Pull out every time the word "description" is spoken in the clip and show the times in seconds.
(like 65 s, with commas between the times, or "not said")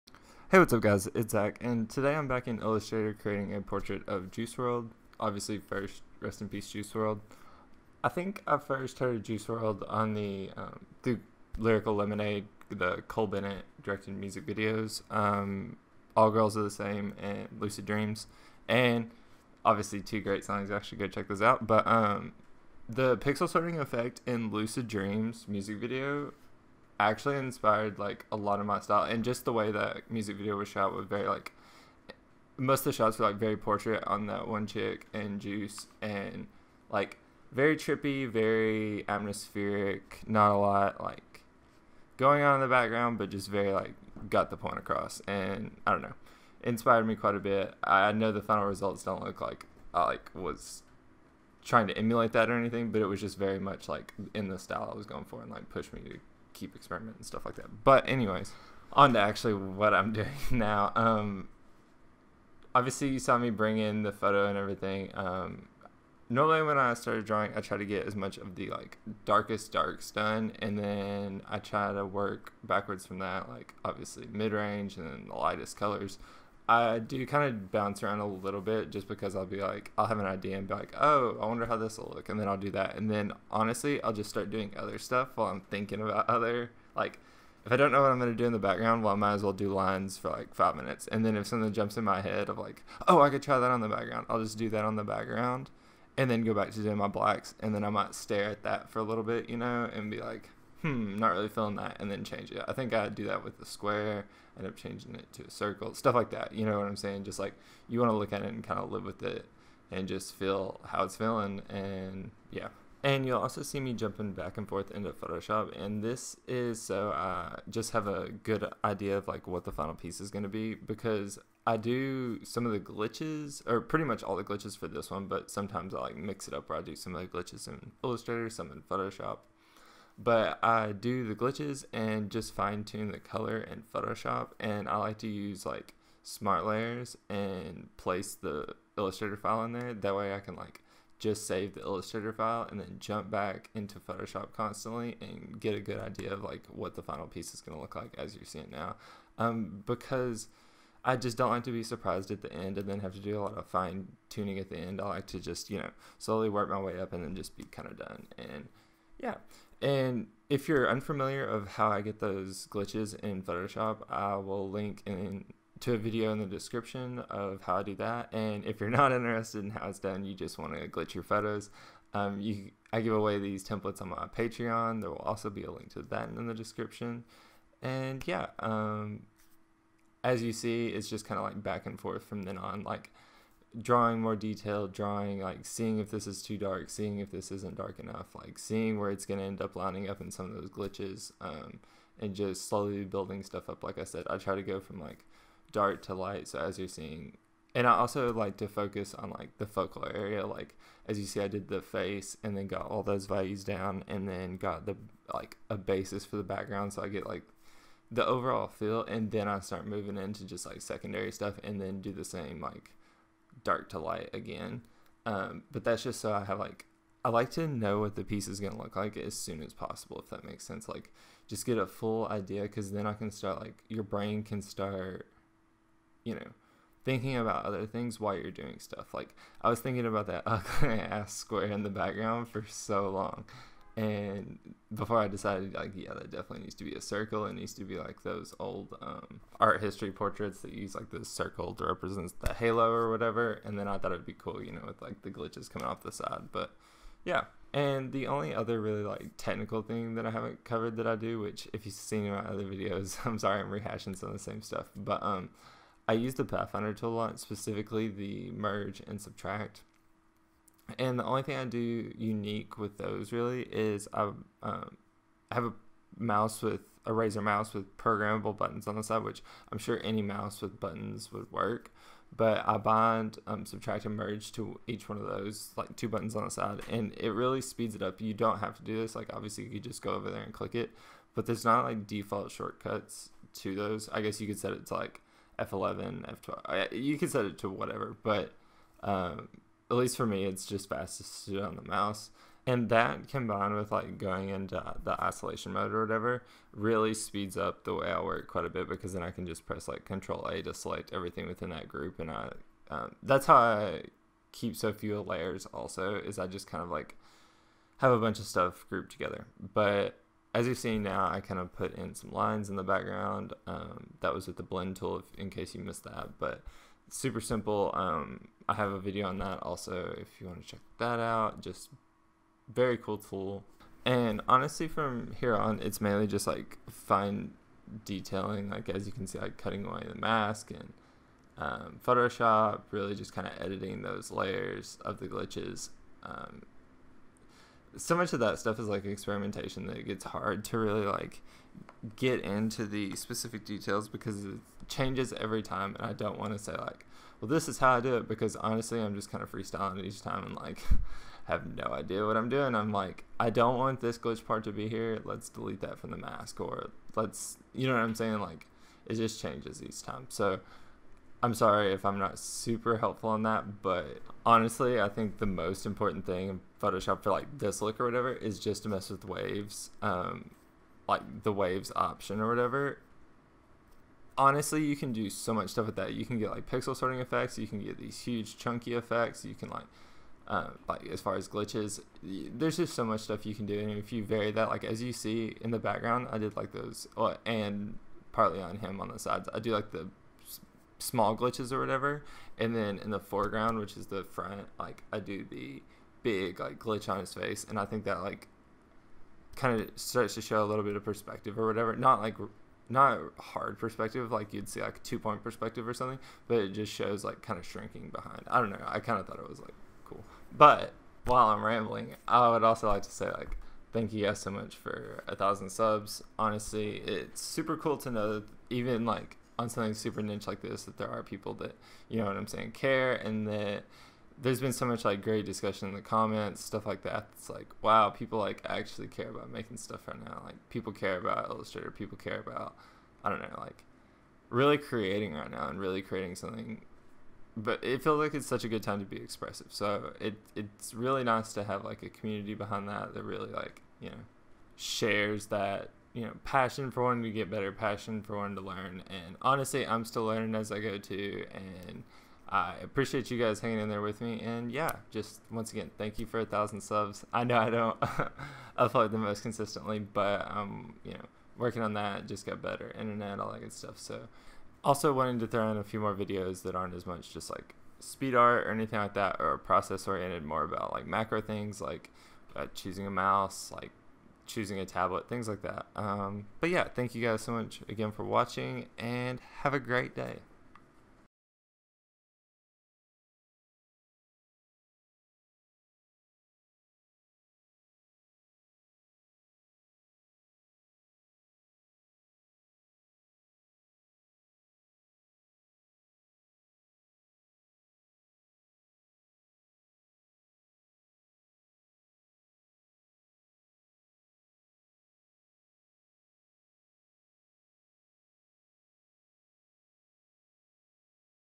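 166 s, 176 s.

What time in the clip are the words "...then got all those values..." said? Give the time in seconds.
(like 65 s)
202 s.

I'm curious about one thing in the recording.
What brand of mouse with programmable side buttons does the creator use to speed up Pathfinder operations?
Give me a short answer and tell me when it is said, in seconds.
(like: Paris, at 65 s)
Razer, at 267 s.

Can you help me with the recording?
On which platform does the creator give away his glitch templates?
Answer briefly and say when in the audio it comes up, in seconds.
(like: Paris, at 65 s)
Patreon, at 174 s.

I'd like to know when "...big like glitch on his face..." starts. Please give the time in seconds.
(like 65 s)
396 s.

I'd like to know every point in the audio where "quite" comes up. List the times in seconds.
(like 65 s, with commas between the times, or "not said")
47 s, 298 s.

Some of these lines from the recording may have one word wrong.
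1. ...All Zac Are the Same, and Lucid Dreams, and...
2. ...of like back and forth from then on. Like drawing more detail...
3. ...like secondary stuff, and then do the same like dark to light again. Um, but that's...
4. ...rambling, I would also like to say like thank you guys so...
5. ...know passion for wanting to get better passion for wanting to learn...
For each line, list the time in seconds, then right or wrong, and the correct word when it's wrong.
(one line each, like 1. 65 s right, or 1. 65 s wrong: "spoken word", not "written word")
1. 16 s wrong: "Girls", not "Zac"
2. 181 s right
3. 210 s right
4. 411 s right
5. 446 s right.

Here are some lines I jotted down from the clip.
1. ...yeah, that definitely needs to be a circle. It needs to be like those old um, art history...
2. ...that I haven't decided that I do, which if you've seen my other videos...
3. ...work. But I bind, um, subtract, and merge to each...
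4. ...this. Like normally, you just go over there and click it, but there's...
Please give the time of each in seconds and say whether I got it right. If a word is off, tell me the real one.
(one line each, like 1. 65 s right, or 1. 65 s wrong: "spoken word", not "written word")
1. 235 s right
2. 250 s wrong: "covered", not "decided"
3. 271 s right
4. 279 s wrong: "obviously", not "normally".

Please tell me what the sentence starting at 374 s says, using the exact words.
Honestly, you can do so much stuff with that.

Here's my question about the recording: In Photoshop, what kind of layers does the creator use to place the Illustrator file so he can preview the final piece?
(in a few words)
smart layers.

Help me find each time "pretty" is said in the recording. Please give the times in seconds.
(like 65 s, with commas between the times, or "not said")
123 s.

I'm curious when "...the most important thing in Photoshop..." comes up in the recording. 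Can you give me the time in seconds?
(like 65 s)
365 s.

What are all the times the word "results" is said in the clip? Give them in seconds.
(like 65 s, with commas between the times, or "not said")
48 s.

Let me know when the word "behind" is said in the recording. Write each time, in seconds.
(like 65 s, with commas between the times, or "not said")
408 s, 442 s.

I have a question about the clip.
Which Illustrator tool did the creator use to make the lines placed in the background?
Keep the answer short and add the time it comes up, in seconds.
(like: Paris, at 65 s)
blend tool, at 314 s.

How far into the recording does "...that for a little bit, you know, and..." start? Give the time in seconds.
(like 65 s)
98 s.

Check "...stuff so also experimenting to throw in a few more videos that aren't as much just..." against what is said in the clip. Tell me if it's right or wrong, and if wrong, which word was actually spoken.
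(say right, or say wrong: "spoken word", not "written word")
wrong: "wanting", not "experimenting".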